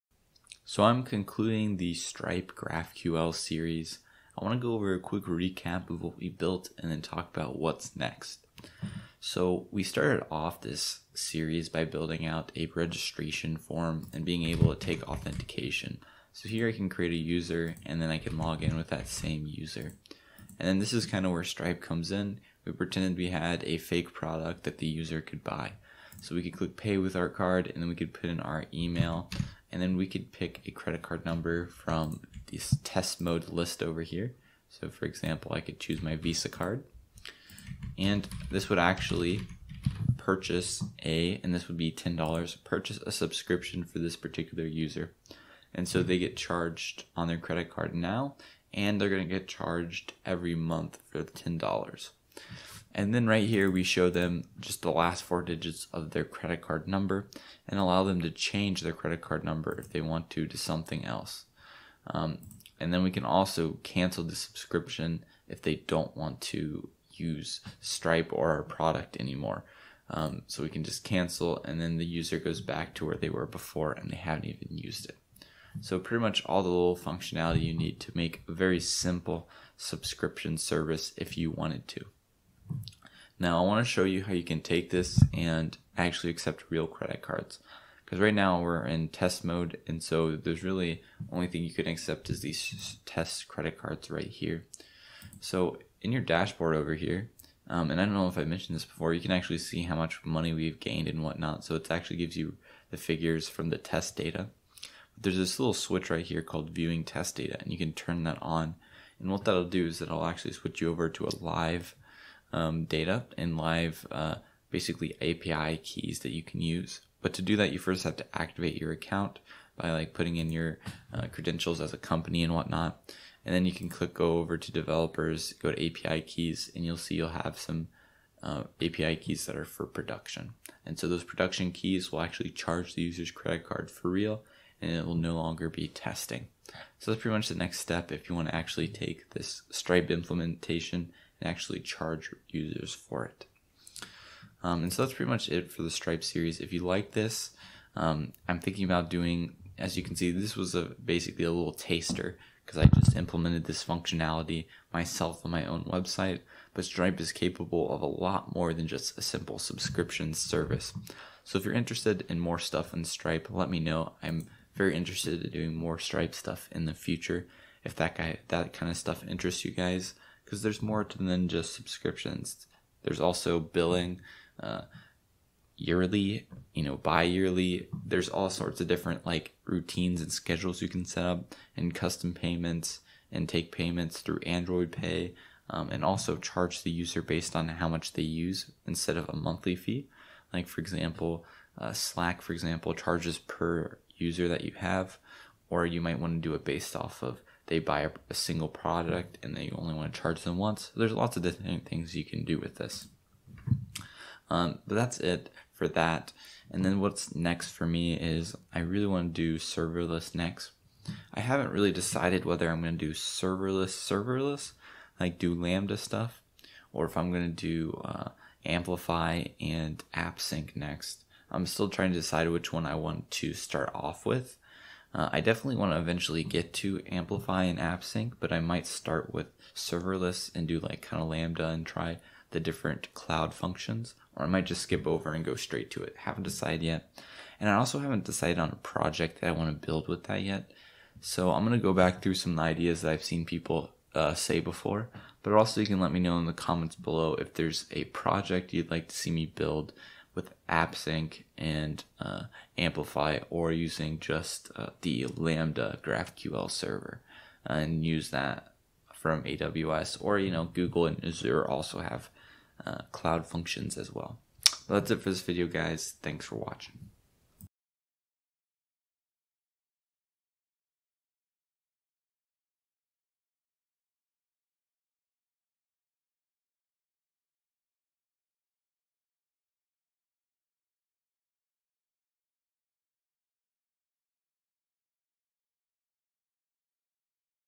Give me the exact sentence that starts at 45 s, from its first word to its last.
And so they get charged on their credit card now, and they're going to get charged every month for $10.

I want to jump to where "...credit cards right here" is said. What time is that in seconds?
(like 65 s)
93 s.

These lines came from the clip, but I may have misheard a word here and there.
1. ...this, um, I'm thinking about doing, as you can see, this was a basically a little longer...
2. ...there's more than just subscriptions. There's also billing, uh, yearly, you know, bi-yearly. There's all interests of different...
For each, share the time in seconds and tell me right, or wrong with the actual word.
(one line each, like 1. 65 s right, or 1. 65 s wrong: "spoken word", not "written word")
1. 147 s wrong: "taster", not "longer"
2. 170 s wrong: "sorts", not "interests".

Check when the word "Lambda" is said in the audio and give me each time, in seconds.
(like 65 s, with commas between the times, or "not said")
215 s, 231 s, 255 s.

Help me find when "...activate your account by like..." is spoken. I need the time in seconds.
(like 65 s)
118 s.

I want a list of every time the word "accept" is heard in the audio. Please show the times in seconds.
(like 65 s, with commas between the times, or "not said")
86 s, 91 s.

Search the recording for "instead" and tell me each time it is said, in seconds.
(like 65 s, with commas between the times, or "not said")
188 s.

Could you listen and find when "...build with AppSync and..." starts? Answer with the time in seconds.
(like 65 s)
249 s.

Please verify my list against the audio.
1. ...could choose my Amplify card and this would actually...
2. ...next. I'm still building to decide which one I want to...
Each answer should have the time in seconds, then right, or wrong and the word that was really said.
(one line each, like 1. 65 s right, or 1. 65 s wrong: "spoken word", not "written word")
1. 35 s wrong: "Visa", not "Amplify"
2. 220 s wrong: "trying", not "building".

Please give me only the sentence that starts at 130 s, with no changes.
And so those production keys will actually charge the user's credit card for real, and it will no longer be testing.